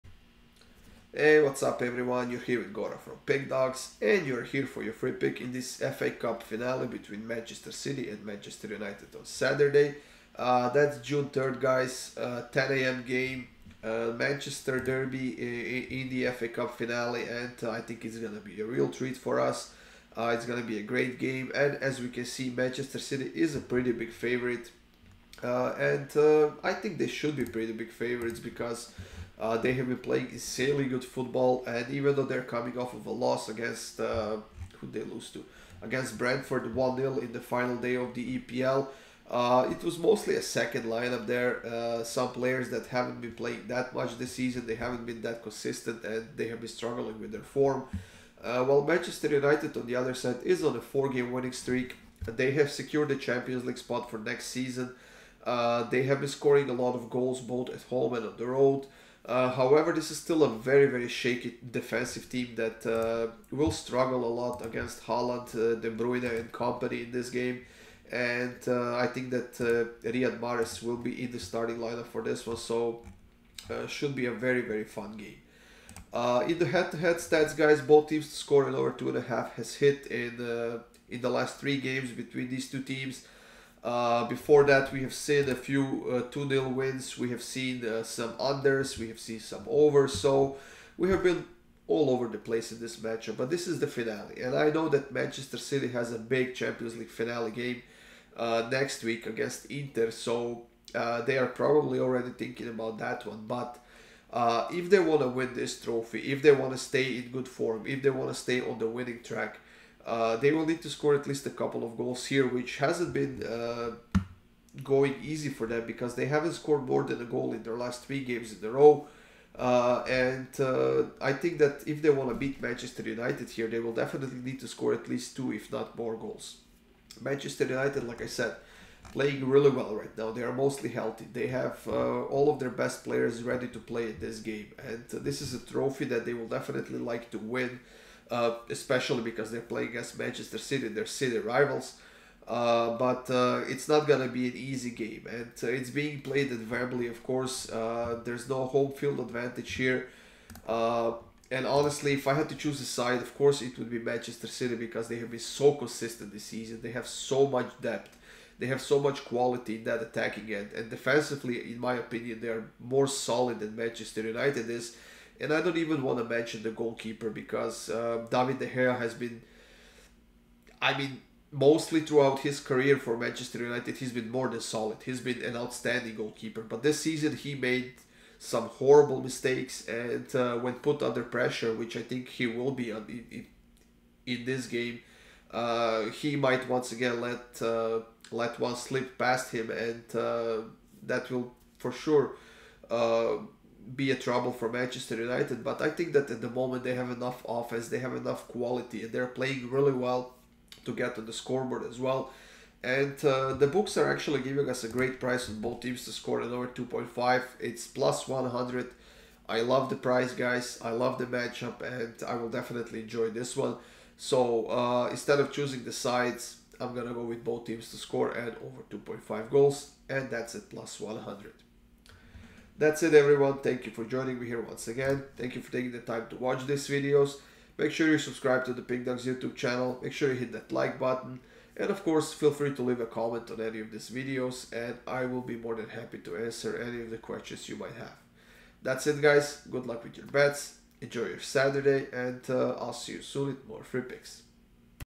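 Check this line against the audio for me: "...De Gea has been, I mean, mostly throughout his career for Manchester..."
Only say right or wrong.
right.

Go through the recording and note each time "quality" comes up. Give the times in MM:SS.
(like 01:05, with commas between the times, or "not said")
02:39, 03:18.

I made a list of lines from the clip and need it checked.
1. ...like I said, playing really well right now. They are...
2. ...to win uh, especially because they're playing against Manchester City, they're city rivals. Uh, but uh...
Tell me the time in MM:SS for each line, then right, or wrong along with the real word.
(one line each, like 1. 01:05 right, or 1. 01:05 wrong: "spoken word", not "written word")
1. 02:08 right
2. 02:17 right.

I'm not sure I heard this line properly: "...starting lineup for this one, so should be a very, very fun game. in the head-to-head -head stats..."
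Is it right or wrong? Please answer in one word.
right.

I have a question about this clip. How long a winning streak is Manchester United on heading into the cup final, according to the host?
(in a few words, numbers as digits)
4 games.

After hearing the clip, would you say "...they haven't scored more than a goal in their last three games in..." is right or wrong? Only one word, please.
right.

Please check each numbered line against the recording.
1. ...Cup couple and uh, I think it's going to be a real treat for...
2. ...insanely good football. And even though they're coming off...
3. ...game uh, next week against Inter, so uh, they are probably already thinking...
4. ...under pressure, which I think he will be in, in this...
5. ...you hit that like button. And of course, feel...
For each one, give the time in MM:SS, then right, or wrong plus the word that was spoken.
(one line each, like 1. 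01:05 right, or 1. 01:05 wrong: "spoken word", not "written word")
1. 00:16 wrong: "finale", not "couple"
2. 00:30 right
3. 01:37 right
4. 03:01 right
5. 03:50 right.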